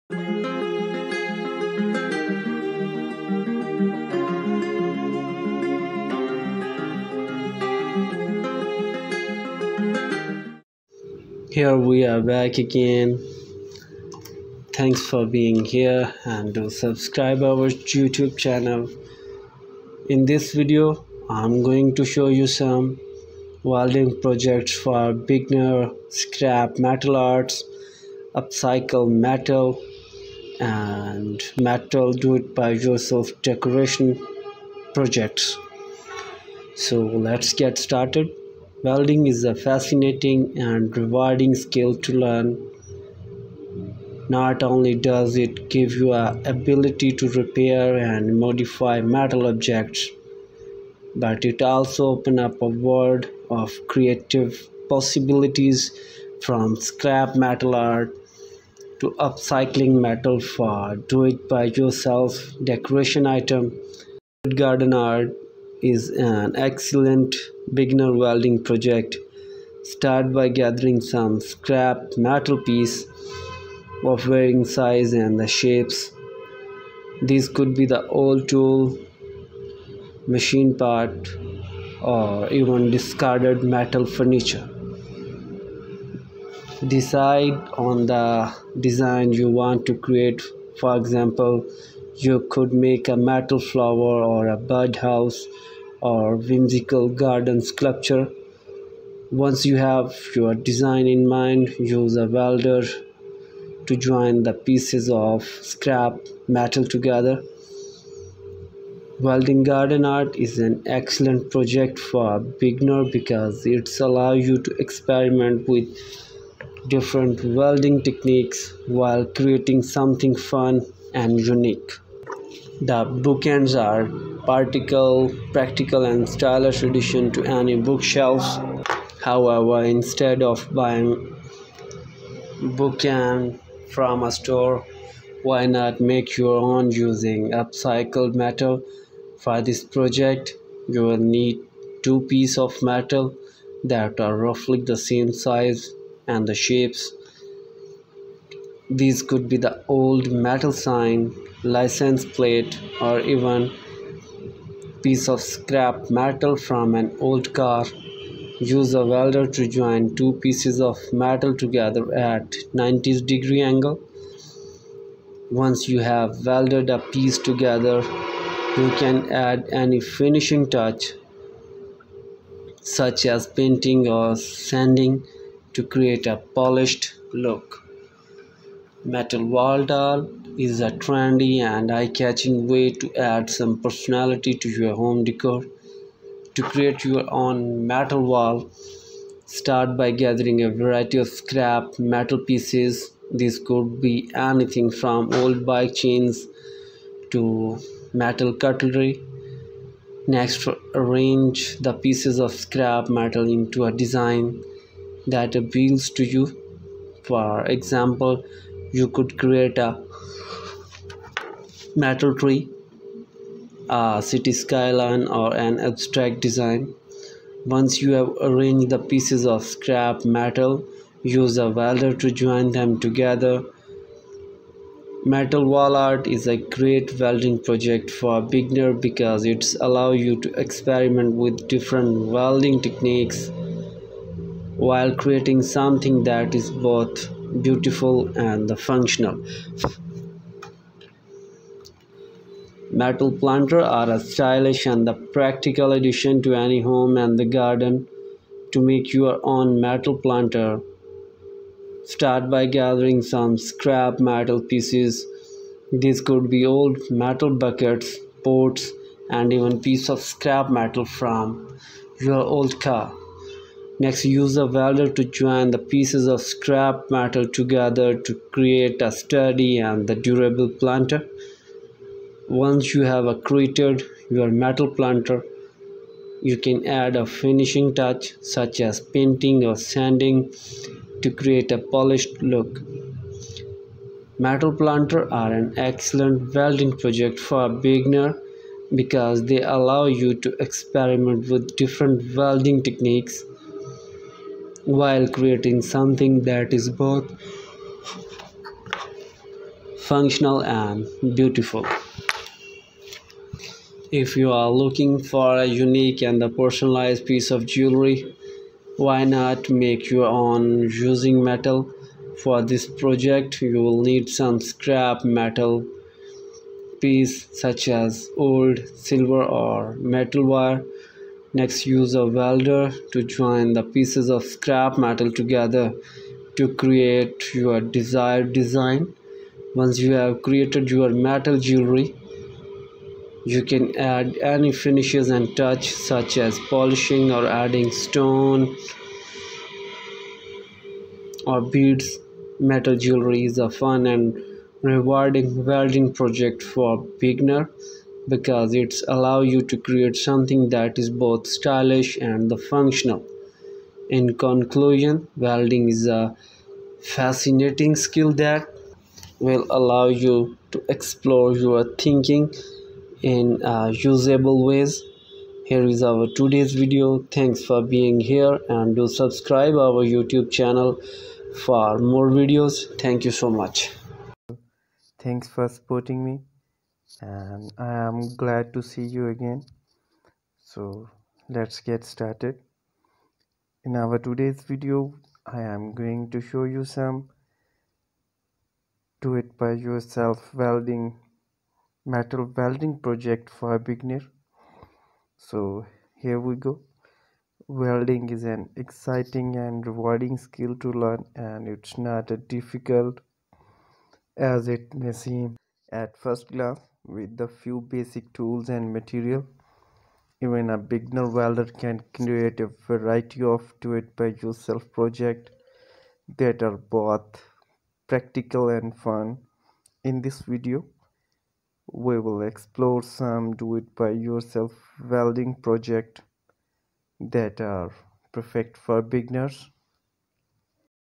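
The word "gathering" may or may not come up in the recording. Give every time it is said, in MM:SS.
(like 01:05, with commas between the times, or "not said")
01:10, 03:10, 04:12.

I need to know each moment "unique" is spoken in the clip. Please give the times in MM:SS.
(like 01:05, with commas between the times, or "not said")
02:01, 05:05.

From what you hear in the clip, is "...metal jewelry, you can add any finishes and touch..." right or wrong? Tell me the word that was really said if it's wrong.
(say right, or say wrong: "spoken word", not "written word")
right.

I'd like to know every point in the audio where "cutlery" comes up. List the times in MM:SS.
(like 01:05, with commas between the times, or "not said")
03:18.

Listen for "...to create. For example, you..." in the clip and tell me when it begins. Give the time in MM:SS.
01:29.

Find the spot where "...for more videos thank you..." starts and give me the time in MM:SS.
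06:11.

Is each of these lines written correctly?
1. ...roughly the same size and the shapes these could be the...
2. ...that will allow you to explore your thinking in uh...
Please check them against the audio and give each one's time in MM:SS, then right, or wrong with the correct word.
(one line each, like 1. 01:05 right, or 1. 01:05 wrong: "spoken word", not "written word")
1. 02:24 right
2. 05:58 right.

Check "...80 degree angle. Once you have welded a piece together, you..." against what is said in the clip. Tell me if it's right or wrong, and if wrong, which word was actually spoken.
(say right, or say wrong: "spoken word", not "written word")
wrong: "90", not "80".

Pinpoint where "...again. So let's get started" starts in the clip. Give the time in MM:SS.
06:19.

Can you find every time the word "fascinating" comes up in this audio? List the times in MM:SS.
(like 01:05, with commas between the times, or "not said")
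00:39, 05:57.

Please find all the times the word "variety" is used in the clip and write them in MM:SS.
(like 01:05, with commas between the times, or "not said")
03:10, 06:52.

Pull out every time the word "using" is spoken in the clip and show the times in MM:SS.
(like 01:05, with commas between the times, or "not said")
02:16, 05:10.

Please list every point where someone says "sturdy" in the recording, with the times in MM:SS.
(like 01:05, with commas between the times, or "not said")
04:29.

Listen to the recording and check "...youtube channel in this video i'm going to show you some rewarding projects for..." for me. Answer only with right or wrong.
wrong.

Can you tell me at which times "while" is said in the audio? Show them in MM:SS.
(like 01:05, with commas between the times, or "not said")
01:58, 03:54, 04:54.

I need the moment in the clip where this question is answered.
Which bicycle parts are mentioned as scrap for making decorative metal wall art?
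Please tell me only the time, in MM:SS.
03:15.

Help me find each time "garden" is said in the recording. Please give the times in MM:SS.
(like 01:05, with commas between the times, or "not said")
01:04, 01:37, 01:49, 04:07.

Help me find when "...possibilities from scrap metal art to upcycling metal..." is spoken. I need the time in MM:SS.
00:54.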